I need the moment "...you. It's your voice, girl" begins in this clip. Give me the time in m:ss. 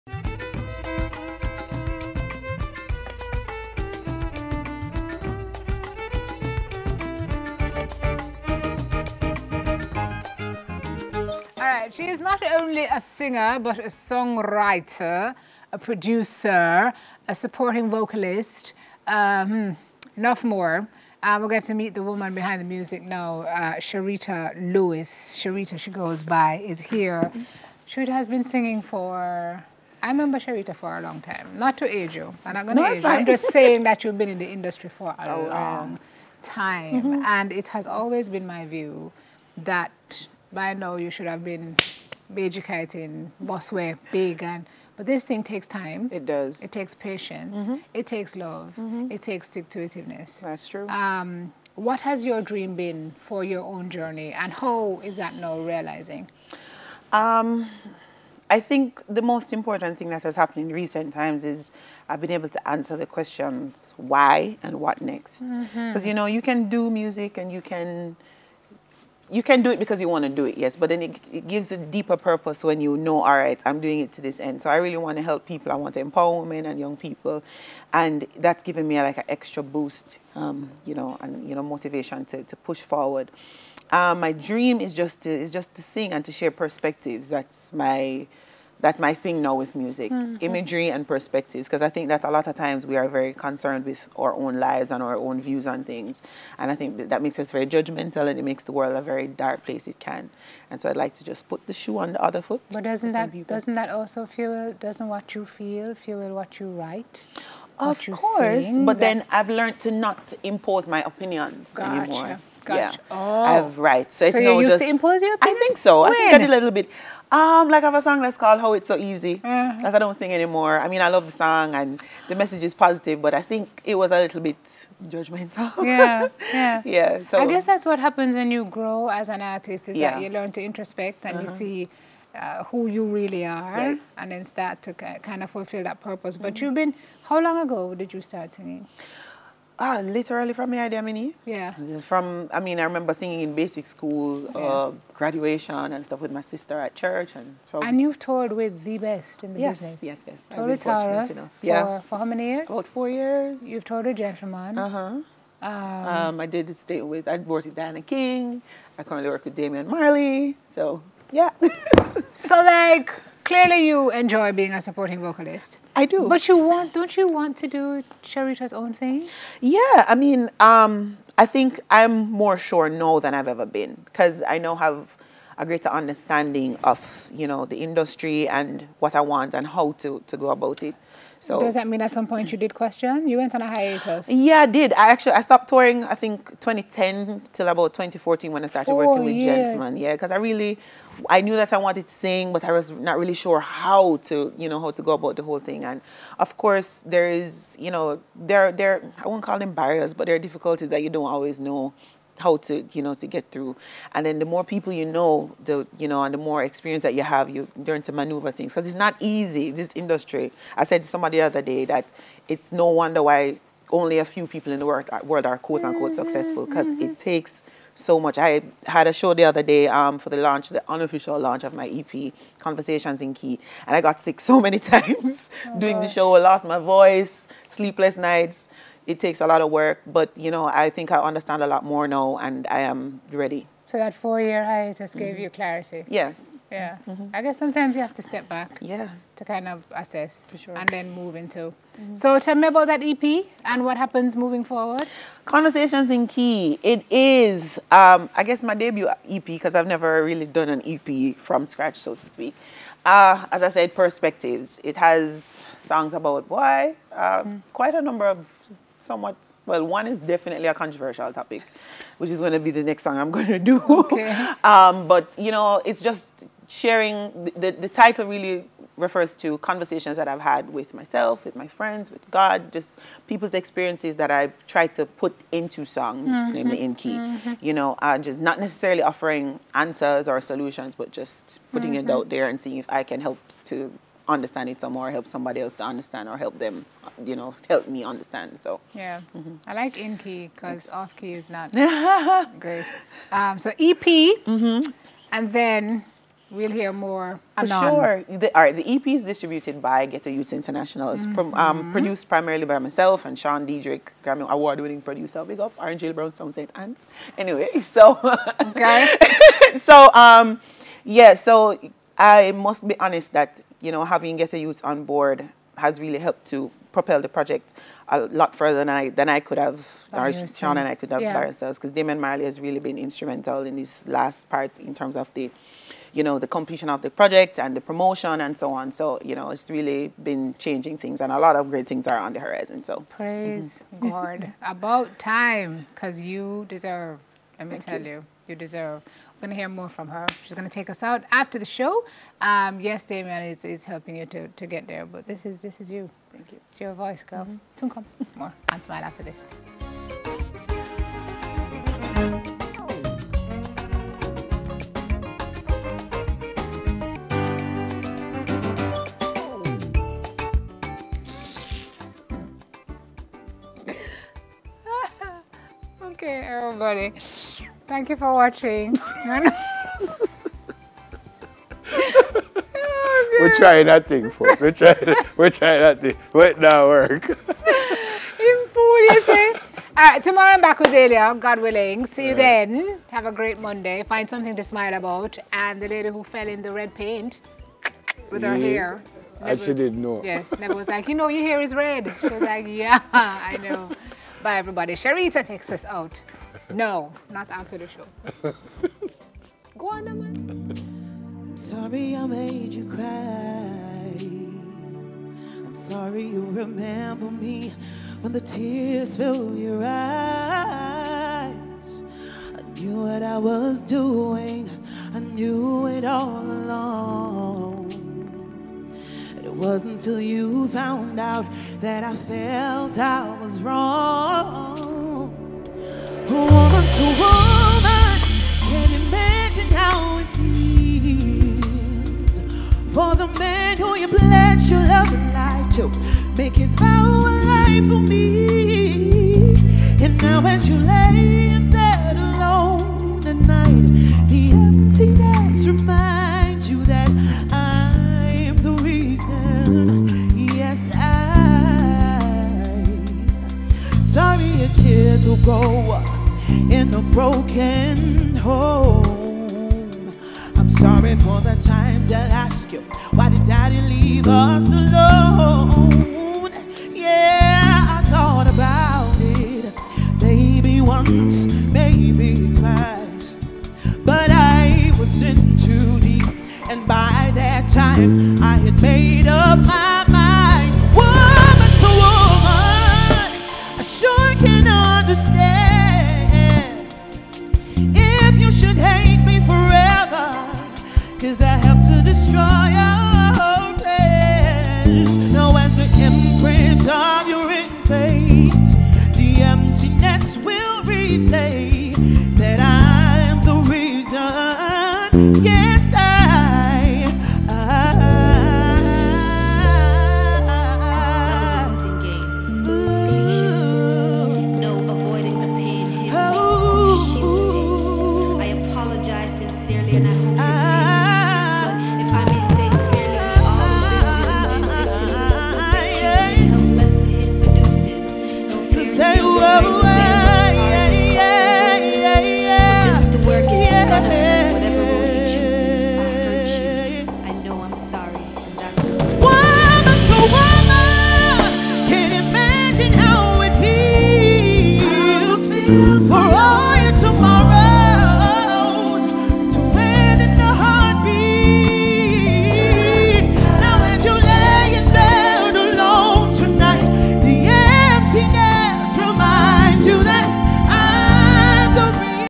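5:46.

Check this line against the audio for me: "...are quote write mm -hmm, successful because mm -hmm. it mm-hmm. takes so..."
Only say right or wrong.
wrong.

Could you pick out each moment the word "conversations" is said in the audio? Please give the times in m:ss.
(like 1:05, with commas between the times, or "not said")
3:42, 4:05, 4:29.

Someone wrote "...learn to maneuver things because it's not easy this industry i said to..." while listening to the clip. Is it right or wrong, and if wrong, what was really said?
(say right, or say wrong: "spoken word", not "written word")
right.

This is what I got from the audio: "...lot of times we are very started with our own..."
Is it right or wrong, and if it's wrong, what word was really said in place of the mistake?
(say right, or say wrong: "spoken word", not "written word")
wrong: "concerned", not "started".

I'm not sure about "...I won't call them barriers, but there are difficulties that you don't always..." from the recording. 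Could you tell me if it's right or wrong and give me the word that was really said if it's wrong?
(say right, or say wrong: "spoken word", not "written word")
right.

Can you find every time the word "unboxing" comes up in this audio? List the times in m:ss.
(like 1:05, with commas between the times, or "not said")
not said.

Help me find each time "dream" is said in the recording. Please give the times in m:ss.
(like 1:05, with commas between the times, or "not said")
0:52, 1:24.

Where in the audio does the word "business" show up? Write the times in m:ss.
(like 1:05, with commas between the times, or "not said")
2:29.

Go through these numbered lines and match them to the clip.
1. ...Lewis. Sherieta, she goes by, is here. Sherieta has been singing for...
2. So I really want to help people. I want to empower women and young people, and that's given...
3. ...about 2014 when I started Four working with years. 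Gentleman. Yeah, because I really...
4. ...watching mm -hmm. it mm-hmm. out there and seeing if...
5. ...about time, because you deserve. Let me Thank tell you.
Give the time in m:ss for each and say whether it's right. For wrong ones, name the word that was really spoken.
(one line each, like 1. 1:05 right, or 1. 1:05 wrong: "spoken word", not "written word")
1. 0:24 right
2. 1:14 right
3. 3:07 right
4. 4:41 wrong: "putting", not "watching"
5. 5:34 right.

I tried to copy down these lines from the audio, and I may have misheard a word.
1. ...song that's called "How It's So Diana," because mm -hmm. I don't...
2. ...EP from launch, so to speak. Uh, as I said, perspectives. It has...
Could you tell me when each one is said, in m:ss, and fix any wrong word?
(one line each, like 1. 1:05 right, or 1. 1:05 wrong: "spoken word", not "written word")
1. 1:58 wrong: "Easy", not "Diana"
2. 4:10 wrong: "scratch", not "launch".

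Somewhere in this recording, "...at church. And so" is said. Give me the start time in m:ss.
2:26.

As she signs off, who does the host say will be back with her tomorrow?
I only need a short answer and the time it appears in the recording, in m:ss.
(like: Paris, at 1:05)
Delia, at 6:20.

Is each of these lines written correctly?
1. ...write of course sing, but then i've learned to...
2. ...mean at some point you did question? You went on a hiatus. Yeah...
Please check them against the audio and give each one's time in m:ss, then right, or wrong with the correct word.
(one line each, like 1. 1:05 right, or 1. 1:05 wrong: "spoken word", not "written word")
1. 1:46 right
2. 3:01 right.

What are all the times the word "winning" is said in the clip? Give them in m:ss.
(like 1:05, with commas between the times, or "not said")
5:04.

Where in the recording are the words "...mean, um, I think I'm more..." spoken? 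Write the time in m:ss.
2:50.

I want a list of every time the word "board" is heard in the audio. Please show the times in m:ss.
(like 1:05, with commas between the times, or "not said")
5:15.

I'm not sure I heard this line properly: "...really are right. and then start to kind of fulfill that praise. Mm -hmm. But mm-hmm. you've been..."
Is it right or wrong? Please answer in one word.
wrong.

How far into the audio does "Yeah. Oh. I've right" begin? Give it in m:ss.
1:52.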